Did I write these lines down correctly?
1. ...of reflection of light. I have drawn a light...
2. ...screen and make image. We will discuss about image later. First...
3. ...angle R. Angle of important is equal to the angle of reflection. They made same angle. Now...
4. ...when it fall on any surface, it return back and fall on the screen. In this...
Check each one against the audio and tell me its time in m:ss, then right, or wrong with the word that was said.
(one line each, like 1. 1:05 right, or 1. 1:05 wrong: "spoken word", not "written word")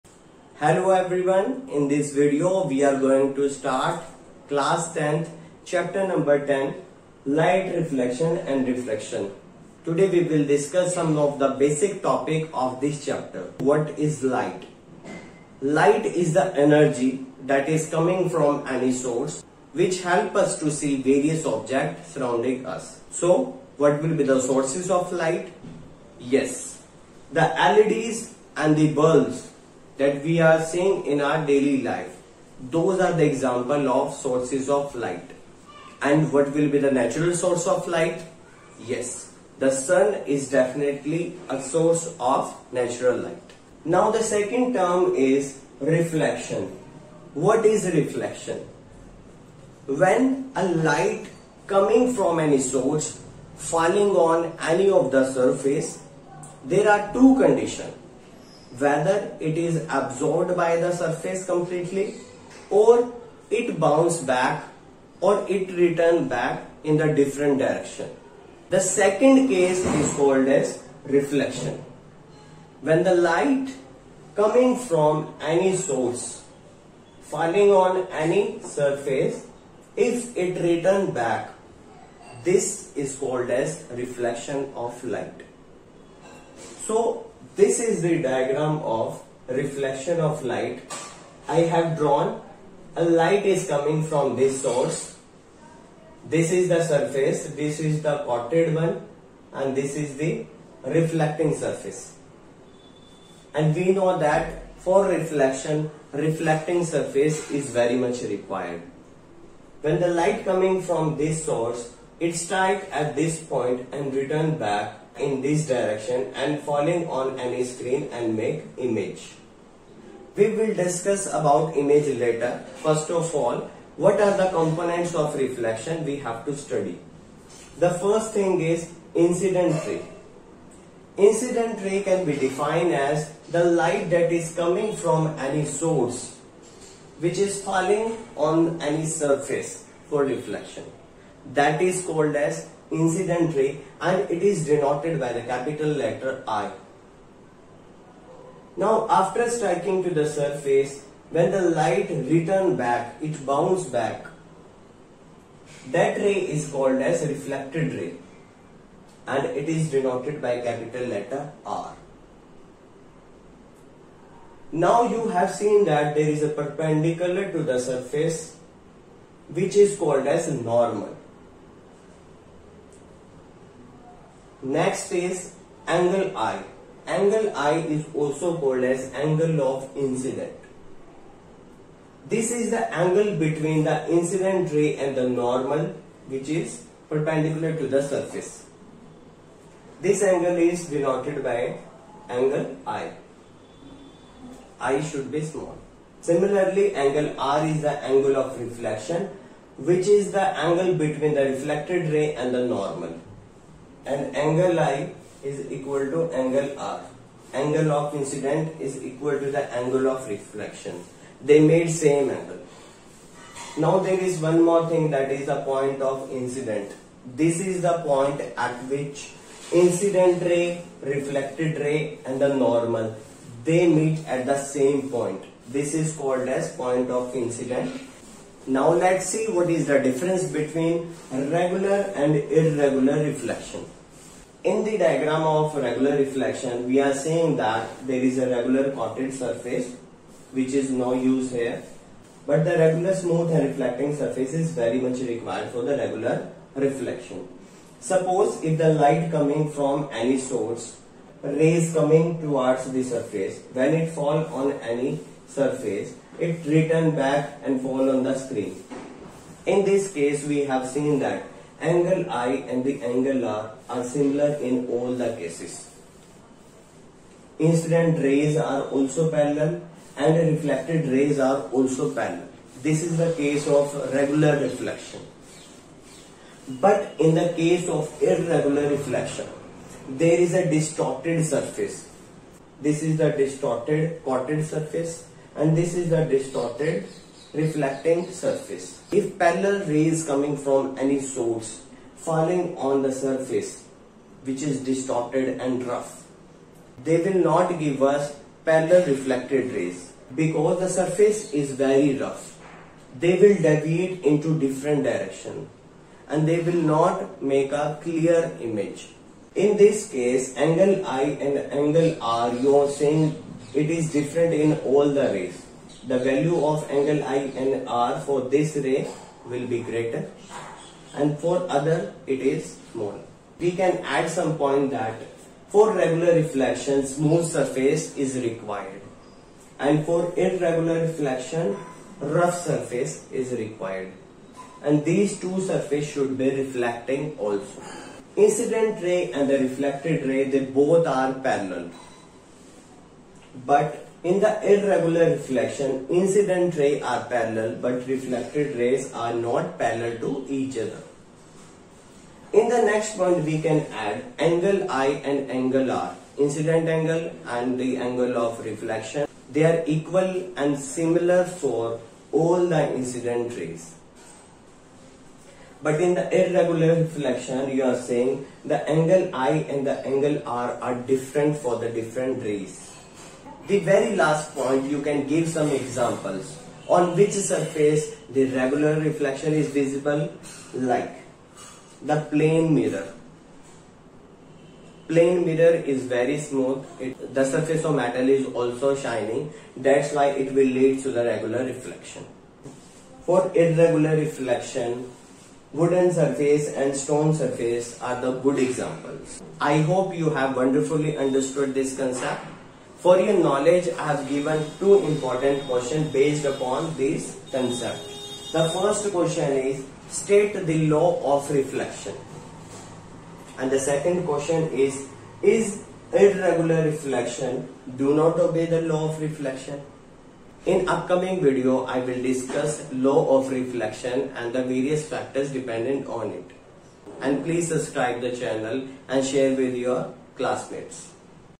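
1. 1:28 right
2. 1:57 right
3. 3:26 wrong: "incident", not "important"
4. 4:13 right.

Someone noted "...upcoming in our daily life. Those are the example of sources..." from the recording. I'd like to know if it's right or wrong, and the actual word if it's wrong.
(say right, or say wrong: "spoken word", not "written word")
wrong: "seeing", not "upcoming".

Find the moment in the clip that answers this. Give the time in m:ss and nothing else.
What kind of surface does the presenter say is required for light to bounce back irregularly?
5:32.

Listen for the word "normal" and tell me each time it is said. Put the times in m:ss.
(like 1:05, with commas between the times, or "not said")
2:50, 3:05, 3:22, 3:42.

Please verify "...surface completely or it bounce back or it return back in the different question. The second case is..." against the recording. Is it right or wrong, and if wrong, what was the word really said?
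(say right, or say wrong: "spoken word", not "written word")
wrong: "direction", not "question".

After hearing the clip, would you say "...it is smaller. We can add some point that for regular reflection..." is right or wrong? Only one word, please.
right.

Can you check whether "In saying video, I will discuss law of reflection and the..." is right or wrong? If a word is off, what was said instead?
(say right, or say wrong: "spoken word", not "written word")
wrong: "upcoming", not "saying".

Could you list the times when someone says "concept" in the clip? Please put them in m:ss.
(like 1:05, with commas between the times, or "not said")
6:41, 6:47.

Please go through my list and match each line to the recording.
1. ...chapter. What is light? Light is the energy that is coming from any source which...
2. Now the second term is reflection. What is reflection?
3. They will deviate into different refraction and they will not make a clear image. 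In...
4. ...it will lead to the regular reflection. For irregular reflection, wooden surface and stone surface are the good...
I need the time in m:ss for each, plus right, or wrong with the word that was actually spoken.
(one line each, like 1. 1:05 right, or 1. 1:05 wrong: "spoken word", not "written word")
1. 0:13 right
2. 0:43 right
3. 5:03 wrong: "direction", not "refraction"
4. 6:30 right.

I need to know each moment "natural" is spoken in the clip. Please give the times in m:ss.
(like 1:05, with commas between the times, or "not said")
0:36, 0:42.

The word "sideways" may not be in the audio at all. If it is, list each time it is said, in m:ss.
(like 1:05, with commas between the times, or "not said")
not said.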